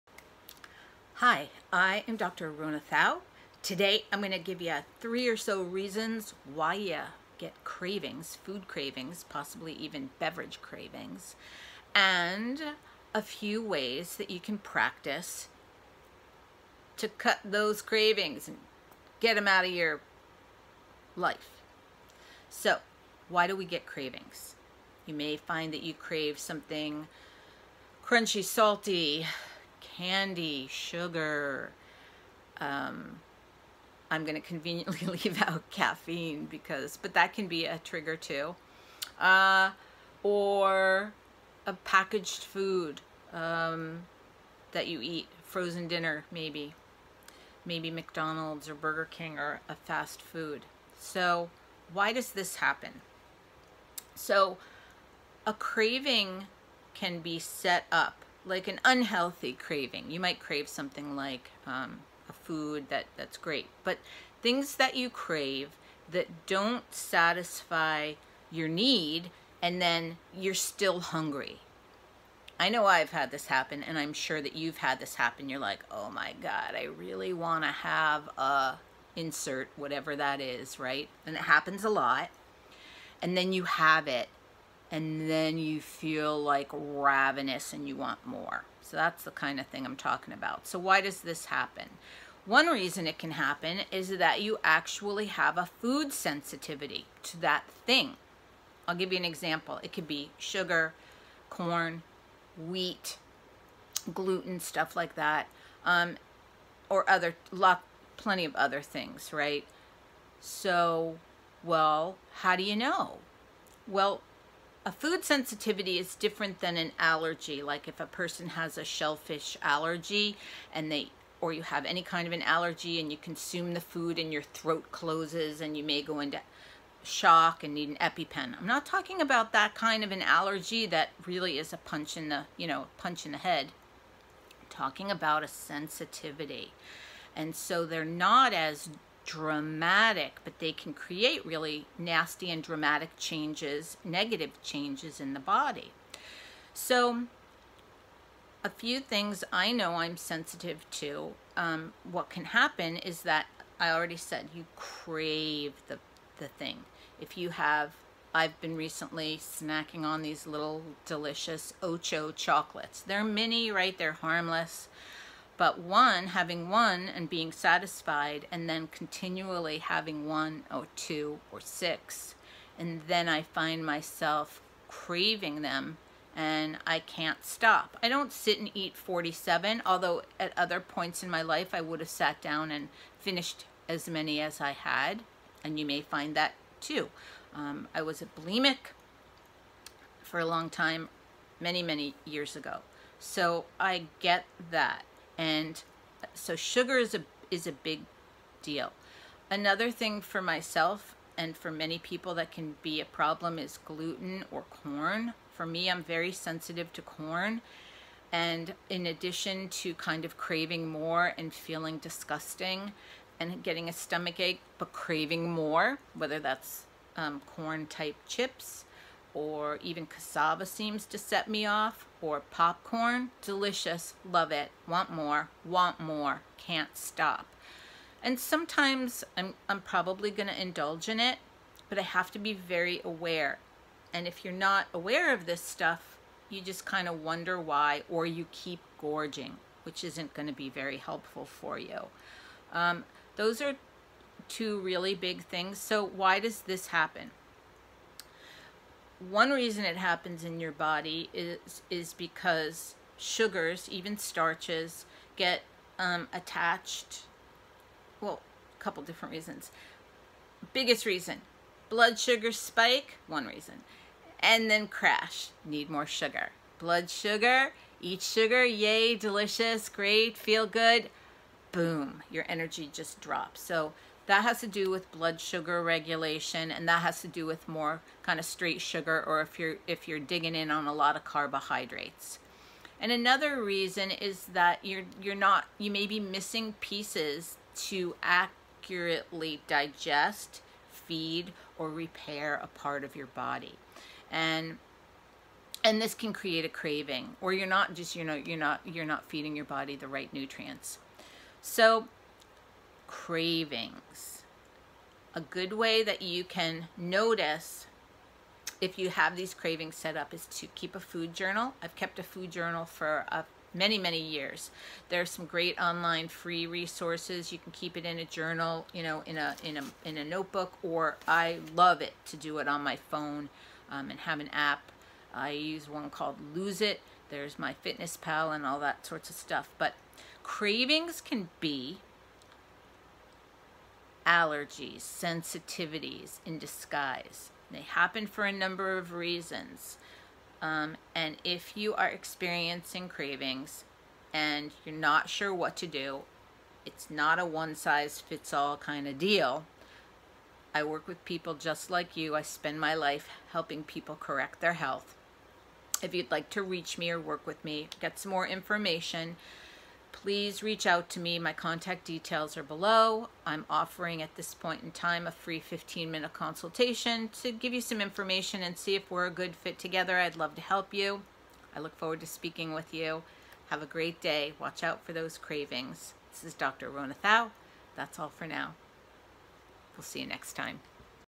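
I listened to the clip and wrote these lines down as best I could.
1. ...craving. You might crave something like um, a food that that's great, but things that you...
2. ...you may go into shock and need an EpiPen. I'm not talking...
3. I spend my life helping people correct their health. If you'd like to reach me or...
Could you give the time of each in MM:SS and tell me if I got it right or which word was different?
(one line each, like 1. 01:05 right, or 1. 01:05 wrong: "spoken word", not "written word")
1. 00:59 right
2. 02:05 right
3. 05:52 right.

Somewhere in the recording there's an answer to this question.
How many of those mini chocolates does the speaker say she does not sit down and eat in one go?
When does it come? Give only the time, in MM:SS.
02:58.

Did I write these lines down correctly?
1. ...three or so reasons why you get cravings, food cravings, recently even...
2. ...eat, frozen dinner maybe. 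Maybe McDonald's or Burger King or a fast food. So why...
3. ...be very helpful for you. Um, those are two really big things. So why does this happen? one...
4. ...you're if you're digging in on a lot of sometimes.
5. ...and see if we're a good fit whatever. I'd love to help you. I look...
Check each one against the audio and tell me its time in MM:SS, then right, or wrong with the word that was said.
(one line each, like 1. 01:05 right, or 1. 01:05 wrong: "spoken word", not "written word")
1. 00:04 wrong: "possibly", not "recently"
2. 00:45 right
3. 04:00 right
4. 04:39 wrong: "carbohydrates", not "sometimes"
5. 06:08 wrong: "together", not "whatever".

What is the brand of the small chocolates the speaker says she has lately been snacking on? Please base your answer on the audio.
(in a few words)
Ocho.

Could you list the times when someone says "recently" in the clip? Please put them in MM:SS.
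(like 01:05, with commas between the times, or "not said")
02:38.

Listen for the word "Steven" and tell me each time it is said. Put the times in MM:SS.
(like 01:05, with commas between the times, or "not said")
not said.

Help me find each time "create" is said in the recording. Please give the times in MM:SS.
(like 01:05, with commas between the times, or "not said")
02:20, 04:56.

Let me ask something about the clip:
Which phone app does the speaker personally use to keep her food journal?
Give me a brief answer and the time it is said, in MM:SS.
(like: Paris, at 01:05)
Lose It, at 05:26.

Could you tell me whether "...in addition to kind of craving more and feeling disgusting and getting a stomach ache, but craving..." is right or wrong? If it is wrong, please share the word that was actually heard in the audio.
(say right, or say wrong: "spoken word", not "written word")
right.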